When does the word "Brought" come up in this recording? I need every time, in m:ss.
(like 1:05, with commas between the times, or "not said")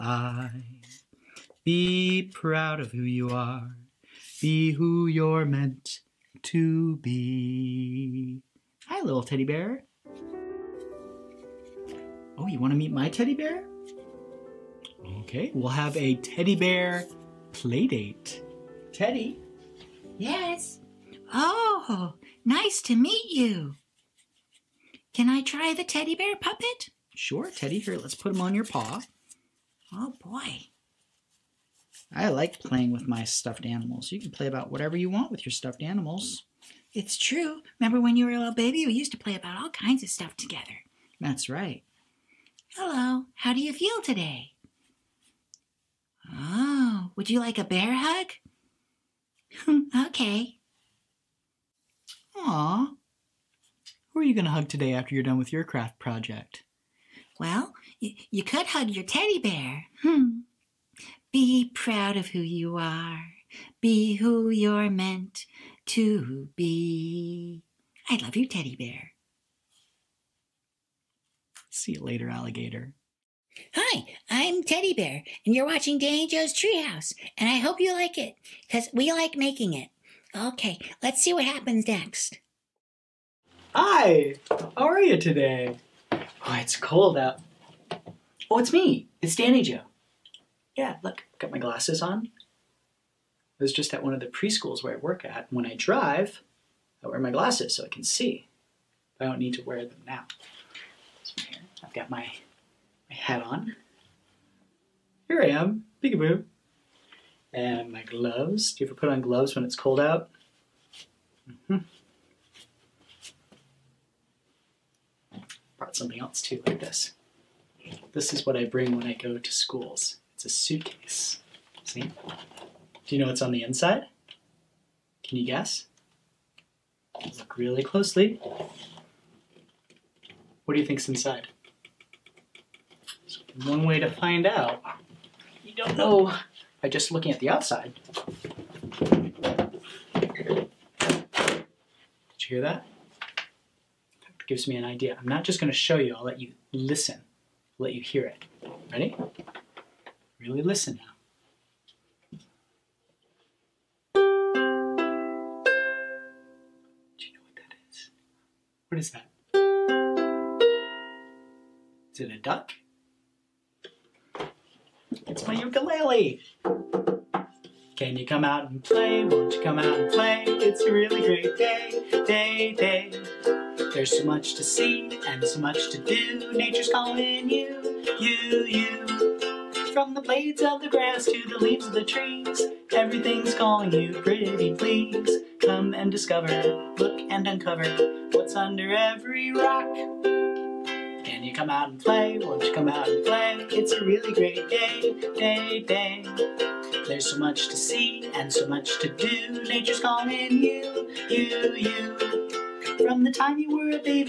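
1:55.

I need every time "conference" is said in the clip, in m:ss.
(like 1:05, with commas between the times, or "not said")
not said.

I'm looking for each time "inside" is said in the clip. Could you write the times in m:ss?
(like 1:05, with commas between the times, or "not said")
2:03, 2:11.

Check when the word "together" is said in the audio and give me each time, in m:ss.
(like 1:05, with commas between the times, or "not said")
0:40.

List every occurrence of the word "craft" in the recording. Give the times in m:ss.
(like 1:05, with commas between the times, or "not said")
0:55.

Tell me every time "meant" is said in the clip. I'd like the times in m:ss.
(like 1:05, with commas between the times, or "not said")
0:05, 1:04.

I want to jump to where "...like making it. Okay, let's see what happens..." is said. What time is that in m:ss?
1:19.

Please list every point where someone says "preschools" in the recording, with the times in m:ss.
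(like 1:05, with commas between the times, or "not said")
1:34.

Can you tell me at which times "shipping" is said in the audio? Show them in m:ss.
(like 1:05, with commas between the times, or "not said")
not said.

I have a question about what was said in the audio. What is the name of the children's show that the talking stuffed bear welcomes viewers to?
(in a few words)
Danny Joe's Treehouse.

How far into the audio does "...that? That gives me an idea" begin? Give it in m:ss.
2:22.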